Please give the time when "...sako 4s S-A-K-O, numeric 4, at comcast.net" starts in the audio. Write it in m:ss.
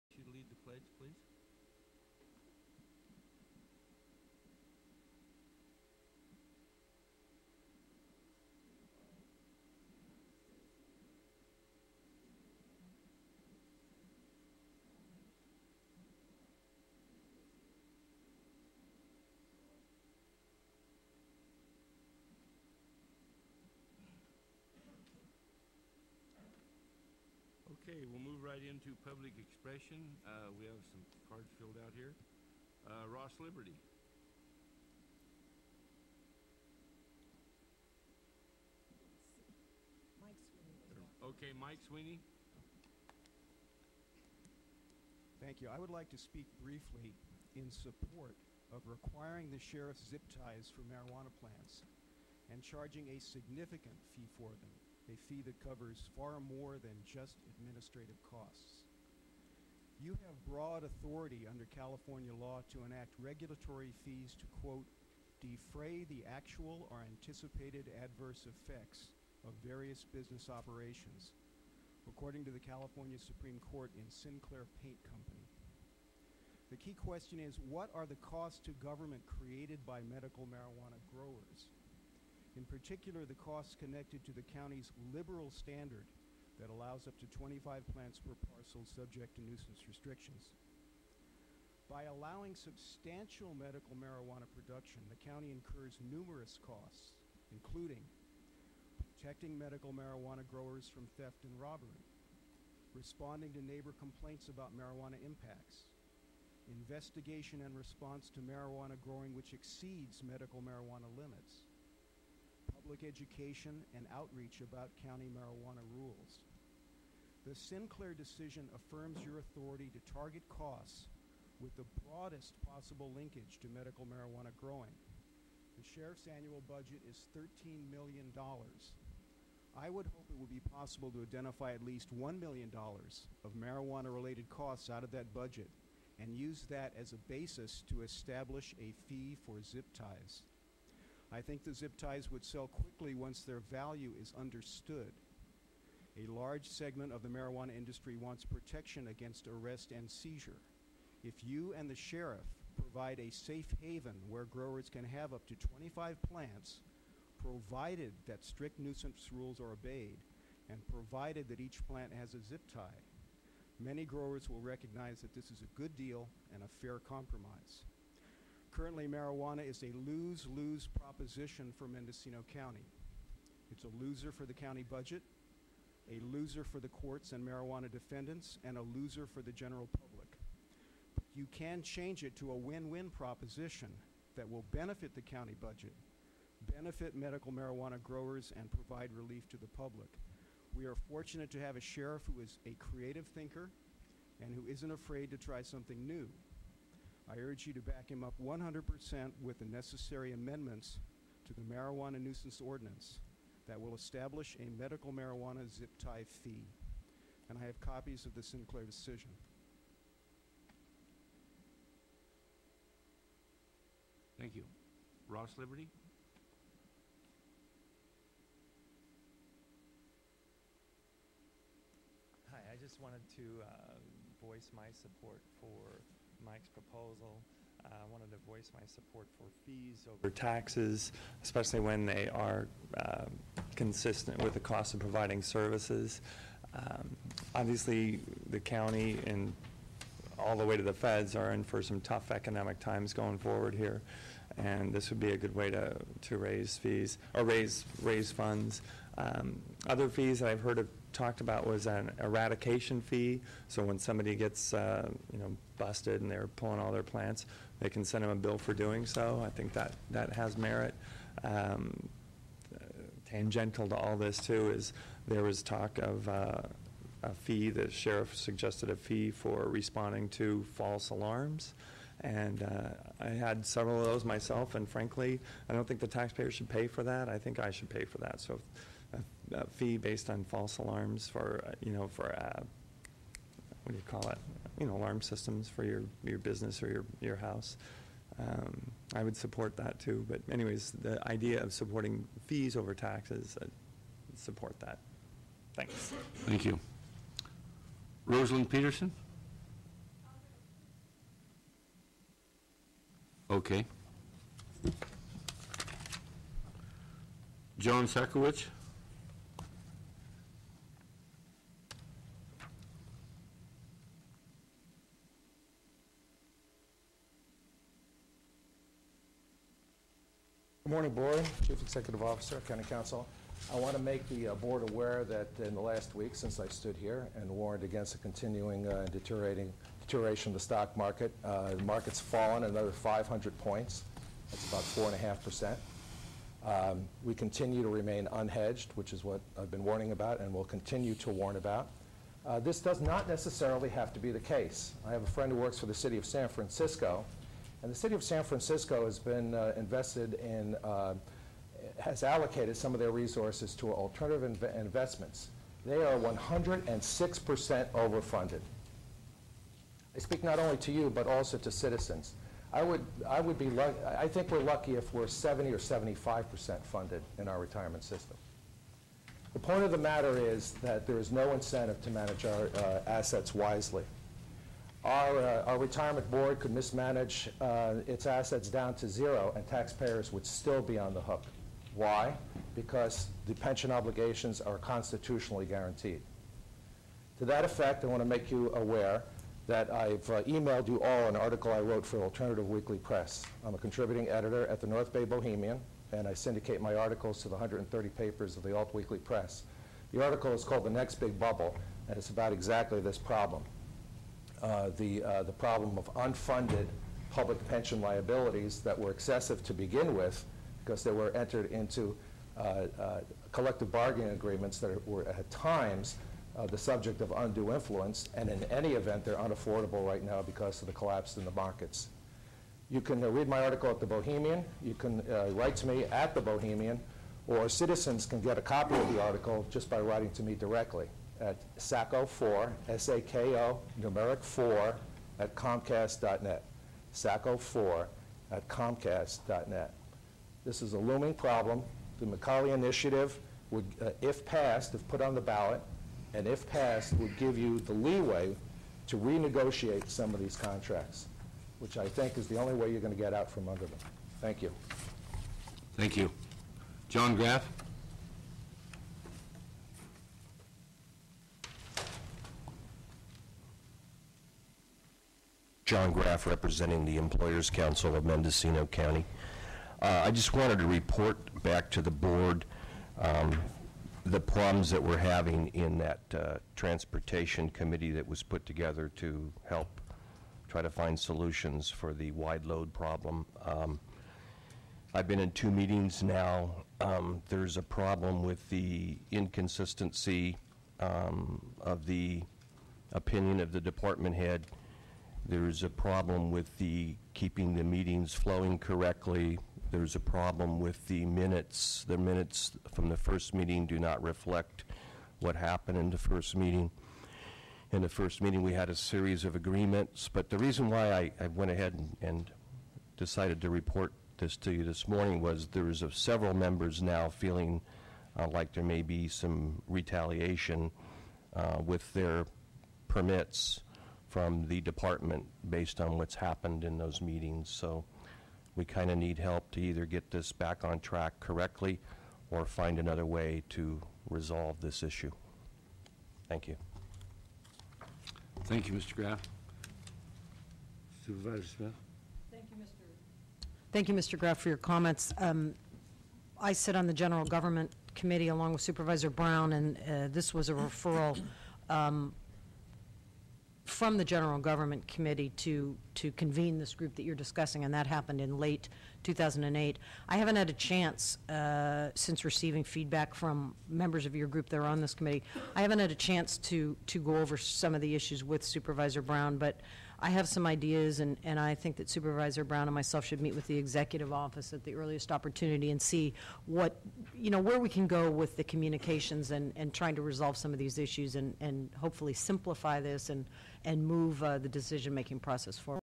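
7:11.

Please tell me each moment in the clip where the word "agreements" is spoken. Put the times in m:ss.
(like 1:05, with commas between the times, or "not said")
6:54, 8:29.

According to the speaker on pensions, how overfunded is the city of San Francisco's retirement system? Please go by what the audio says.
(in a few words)
106%.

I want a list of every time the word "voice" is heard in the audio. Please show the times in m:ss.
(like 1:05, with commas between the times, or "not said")
3:44, 3:48.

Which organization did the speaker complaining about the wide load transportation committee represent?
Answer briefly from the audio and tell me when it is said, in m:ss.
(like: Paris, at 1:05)
Employers Council of Mendocino County, at 7:47.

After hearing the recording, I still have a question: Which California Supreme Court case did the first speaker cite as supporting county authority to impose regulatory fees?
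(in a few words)
Sinclair Paint Company.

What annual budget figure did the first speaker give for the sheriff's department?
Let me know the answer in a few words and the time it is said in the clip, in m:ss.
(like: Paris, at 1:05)
$13 million, at 2:07.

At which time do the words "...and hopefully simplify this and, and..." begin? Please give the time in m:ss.
9:41.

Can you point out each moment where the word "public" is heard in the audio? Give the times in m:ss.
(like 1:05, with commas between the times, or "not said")
0:29, 1:52, 2:59, 3:09, 6:47.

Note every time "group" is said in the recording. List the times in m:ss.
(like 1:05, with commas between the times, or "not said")
9:16, 9:24.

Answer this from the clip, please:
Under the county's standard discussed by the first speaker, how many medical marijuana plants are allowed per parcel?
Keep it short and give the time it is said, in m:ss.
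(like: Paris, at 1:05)
25, at 1:27.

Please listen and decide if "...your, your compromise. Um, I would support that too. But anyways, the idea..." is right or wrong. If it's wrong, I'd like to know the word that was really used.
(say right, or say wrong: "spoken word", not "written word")
wrong: "house", not "compromise".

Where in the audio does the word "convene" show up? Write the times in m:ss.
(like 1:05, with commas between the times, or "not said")
9:16.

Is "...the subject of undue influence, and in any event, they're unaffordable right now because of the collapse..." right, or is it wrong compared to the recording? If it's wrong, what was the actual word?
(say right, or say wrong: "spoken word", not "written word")
right.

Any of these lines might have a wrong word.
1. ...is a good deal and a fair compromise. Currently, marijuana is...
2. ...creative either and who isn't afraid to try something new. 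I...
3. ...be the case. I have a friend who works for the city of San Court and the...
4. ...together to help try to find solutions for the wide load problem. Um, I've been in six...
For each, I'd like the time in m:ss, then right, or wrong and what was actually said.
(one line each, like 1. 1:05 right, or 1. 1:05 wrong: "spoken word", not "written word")
1. 2:45 right
2. 3:12 wrong: "thinker", not "either"
3. 5:44 wrong: "Francisco", not "Court"
4. 7:58 wrong: "two", not "six".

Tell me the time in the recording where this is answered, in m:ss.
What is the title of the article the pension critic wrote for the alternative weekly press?
6:40.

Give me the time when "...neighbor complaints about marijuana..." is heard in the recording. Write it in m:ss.
1:43.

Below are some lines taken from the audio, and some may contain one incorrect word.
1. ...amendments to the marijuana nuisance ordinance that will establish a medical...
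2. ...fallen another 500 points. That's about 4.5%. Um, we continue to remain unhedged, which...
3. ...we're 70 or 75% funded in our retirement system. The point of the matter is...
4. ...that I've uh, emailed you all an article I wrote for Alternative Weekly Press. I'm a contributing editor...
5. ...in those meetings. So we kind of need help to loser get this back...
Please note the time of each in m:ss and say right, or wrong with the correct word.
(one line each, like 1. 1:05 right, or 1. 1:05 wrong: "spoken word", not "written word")
1. 3:20 right
2. 5:32 right
3. 6:05 right
4. 6:29 right
5. 8:46 wrong: "either", not "loser".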